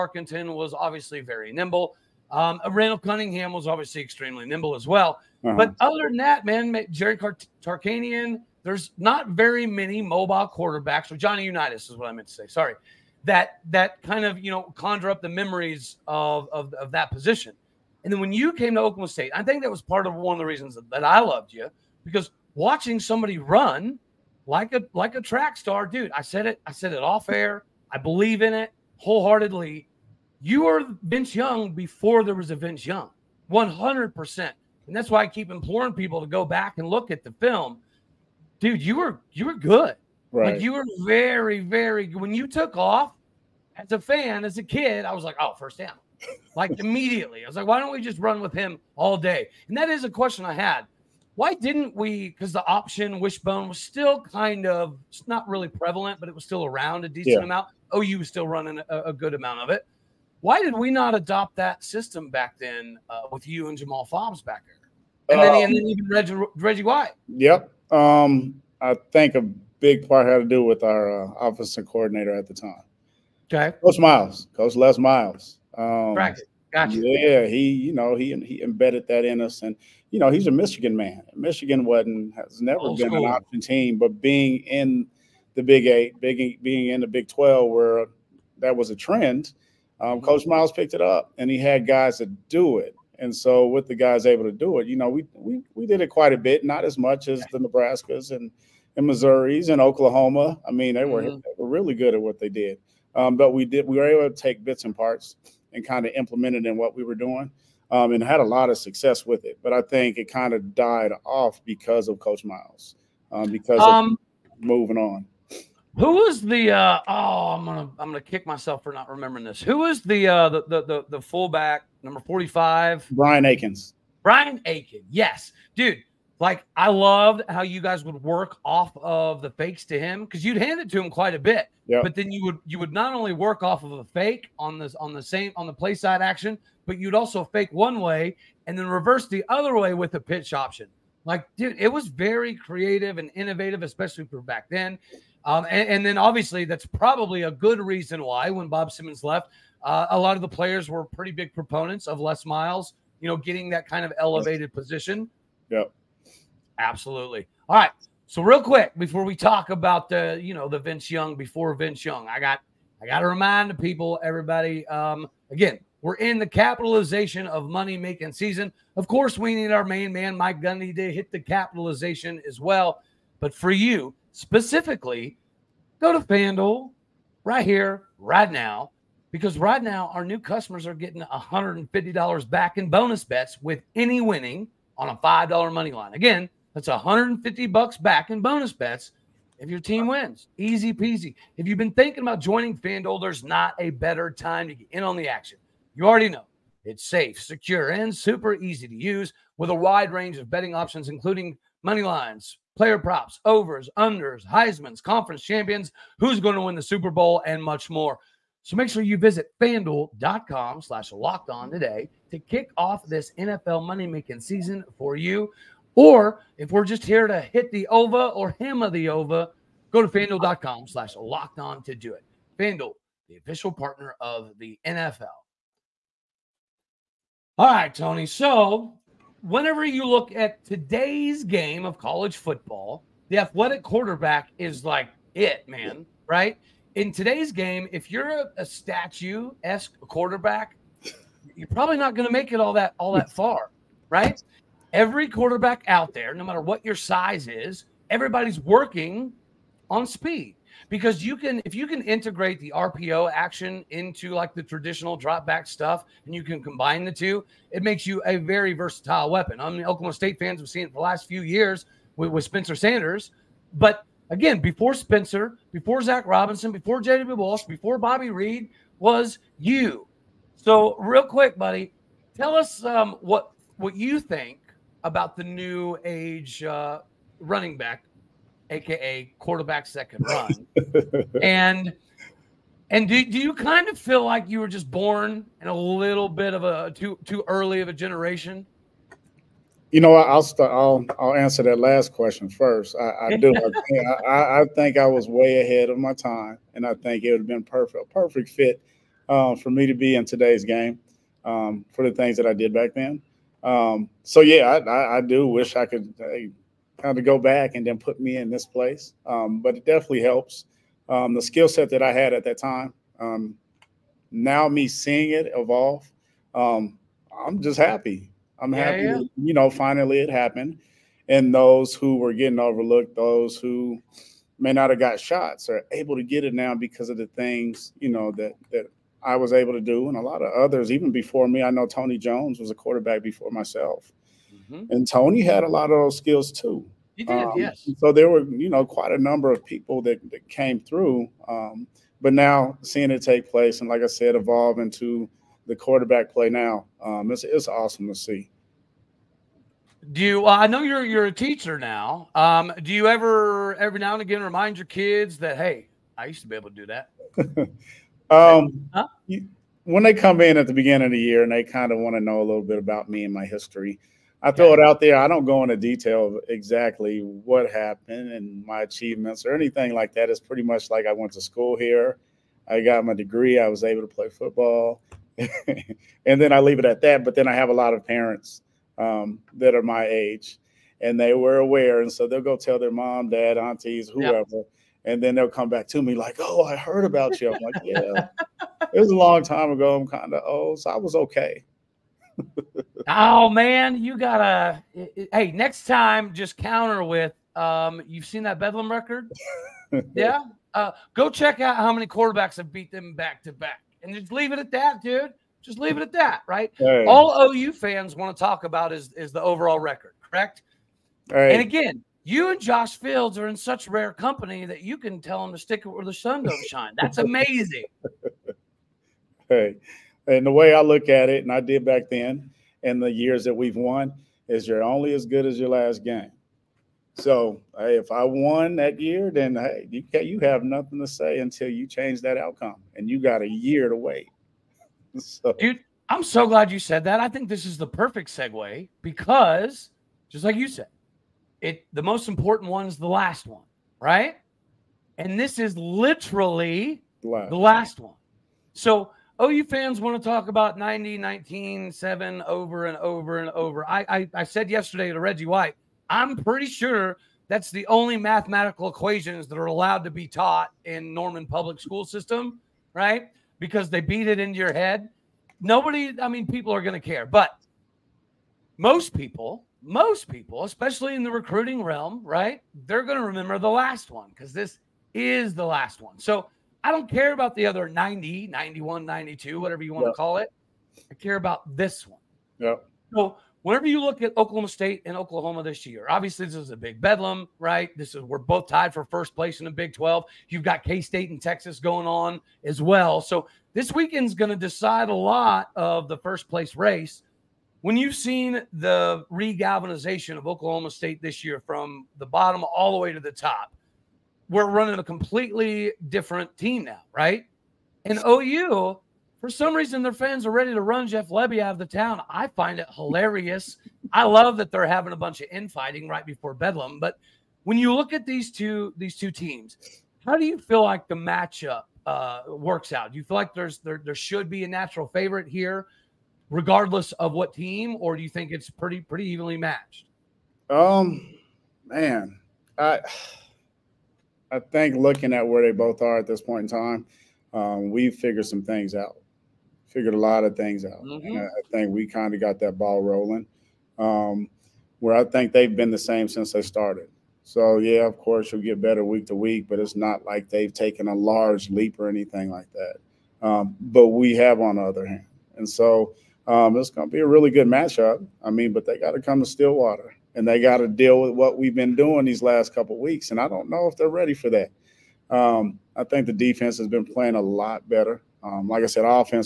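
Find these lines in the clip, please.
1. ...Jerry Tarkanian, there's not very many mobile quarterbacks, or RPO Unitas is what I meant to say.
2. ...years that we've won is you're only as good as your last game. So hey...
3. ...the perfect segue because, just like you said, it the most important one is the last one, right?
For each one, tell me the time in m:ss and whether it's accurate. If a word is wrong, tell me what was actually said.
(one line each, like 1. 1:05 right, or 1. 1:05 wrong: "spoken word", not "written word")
1. 0:06 wrong: "Johnny", not "RPO"
2. 7:03 right
3. 7:17 right.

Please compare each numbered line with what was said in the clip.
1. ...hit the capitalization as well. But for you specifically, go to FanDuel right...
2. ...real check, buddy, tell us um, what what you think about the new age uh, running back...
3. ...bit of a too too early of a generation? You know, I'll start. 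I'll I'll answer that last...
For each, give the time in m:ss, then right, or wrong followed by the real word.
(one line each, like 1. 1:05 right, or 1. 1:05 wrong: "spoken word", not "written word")
1. 2:51 right
2. 4:30 wrong: "quick", not "check"
3. 4:46 right.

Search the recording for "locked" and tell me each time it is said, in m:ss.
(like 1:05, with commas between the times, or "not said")
3:31, 3:41.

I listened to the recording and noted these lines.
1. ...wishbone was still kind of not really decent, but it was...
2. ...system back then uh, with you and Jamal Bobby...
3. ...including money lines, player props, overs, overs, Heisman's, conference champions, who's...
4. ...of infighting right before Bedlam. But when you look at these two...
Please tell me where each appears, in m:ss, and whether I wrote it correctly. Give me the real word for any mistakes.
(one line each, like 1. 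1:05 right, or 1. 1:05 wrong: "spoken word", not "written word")
1. 0:53 wrong: "prevalent", not "decent"
2. 1:01 wrong: "Fobbs", not "Bobby"
3. 3:21 wrong: "unders", not "overs"
4. 8:35 right.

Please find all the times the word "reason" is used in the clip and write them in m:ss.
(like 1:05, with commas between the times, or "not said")
0:20, 2:27, 8:29.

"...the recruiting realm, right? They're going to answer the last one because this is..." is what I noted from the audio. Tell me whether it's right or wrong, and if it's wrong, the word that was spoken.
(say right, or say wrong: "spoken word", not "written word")
wrong: "remember", not "answer".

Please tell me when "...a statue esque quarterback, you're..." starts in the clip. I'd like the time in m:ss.
3:58.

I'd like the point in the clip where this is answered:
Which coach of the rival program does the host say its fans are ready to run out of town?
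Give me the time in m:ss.
8:31.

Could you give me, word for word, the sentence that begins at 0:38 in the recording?
Dude, you were you were good.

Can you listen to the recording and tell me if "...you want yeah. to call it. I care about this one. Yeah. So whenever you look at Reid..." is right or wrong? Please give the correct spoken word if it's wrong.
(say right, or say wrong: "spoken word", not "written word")
wrong: "Oklahoma", not "Reid".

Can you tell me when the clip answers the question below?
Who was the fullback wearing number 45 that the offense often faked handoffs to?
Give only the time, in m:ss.
2:03.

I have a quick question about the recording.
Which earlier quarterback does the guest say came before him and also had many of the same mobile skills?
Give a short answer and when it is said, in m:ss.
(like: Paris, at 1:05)
Tony Jones, at 5:31.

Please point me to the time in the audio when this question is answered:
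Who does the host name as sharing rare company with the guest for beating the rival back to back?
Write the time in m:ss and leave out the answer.
6:52.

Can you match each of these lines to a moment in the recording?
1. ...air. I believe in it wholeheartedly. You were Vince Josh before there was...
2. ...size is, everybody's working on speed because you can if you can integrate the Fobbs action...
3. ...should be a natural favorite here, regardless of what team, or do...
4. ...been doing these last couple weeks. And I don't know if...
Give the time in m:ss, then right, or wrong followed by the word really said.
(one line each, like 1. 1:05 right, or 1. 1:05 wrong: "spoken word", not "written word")
1. 0:27 wrong: "Young", not "Josh"
2. 4:06 wrong: "RPO", not "Fobbs"
3. 8:44 right
4. 9:21 right.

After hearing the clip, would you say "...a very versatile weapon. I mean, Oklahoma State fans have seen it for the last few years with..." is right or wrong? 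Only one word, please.
right.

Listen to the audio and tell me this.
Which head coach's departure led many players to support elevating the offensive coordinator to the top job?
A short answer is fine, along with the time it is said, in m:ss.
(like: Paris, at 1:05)
Bob Simmons, at 2:28.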